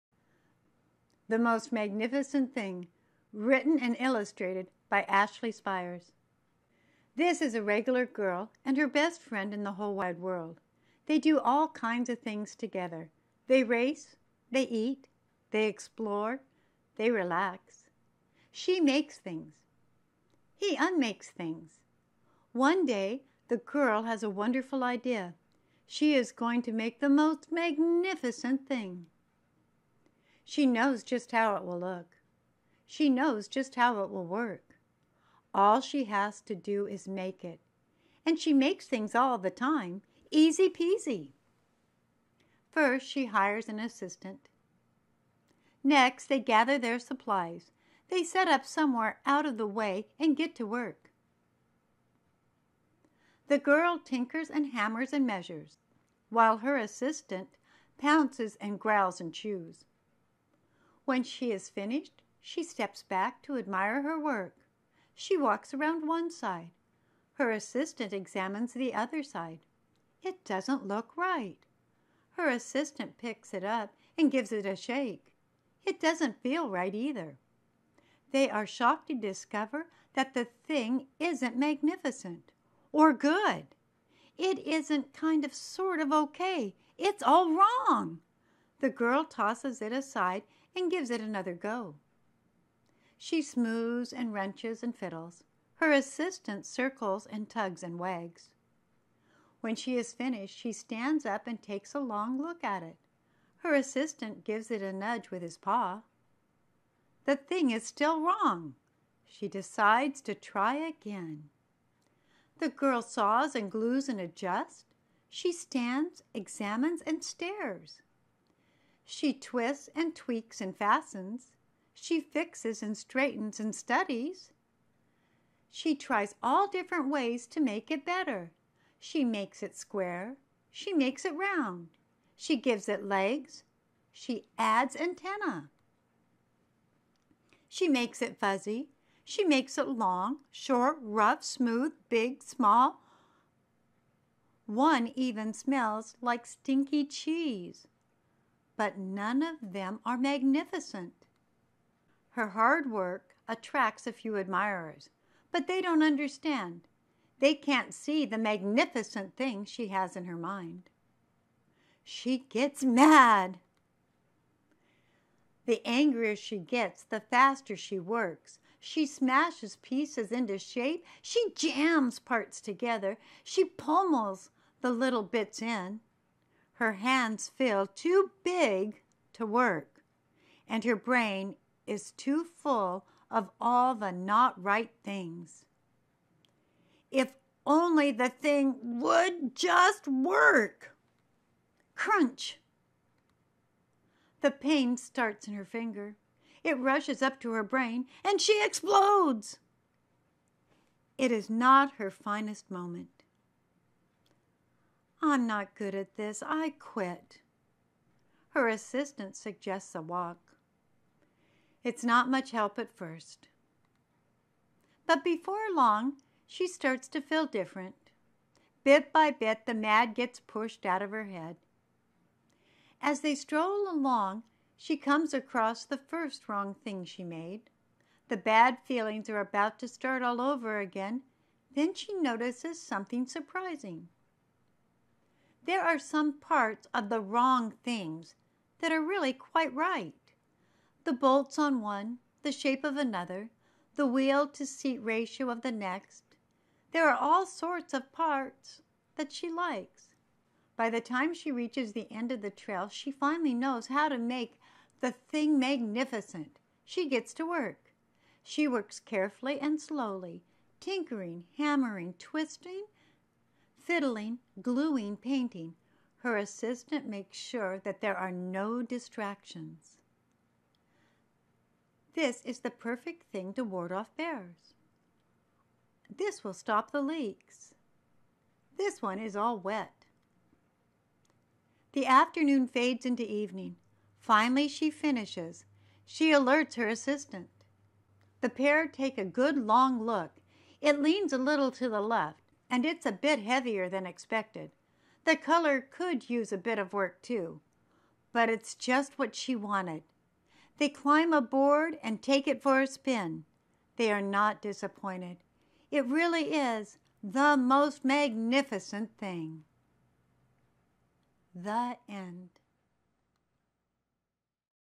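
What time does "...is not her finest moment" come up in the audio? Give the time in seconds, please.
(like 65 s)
201 s.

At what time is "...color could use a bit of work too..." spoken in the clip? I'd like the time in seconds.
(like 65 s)
295 s.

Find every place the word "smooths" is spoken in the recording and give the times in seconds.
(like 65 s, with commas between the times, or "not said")
93 s, 141 s.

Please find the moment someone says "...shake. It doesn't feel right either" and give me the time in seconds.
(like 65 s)
74 s.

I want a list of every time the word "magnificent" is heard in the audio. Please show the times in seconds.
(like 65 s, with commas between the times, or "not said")
1 s, 27 s, 81 s, 150 s, 158 s, 255 s, 308 s.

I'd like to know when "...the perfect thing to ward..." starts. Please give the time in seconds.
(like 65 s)
272 s.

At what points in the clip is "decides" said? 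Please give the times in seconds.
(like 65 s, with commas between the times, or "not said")
109 s.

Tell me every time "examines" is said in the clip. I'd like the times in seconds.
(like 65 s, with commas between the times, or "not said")
68 s, 116 s.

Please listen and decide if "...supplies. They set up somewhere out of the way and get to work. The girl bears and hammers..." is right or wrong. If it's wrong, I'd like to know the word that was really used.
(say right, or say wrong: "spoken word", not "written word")
wrong: "tinkers", not "bears".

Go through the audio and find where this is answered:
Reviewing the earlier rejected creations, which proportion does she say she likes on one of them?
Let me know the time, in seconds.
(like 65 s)
244 s.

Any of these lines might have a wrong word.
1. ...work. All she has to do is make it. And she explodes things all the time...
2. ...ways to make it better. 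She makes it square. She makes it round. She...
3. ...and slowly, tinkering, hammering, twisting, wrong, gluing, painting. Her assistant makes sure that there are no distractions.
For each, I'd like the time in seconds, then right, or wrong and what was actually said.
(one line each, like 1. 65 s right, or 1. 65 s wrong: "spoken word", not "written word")
1. 34 s wrong: "makes", not "explodes"
2. 127 s right
3. 259 s wrong: "fiddling", not "wrong".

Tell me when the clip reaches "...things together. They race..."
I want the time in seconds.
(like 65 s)
12 s.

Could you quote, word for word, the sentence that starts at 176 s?
Her hands feel too big to work, and her brain is too full of all the not right things.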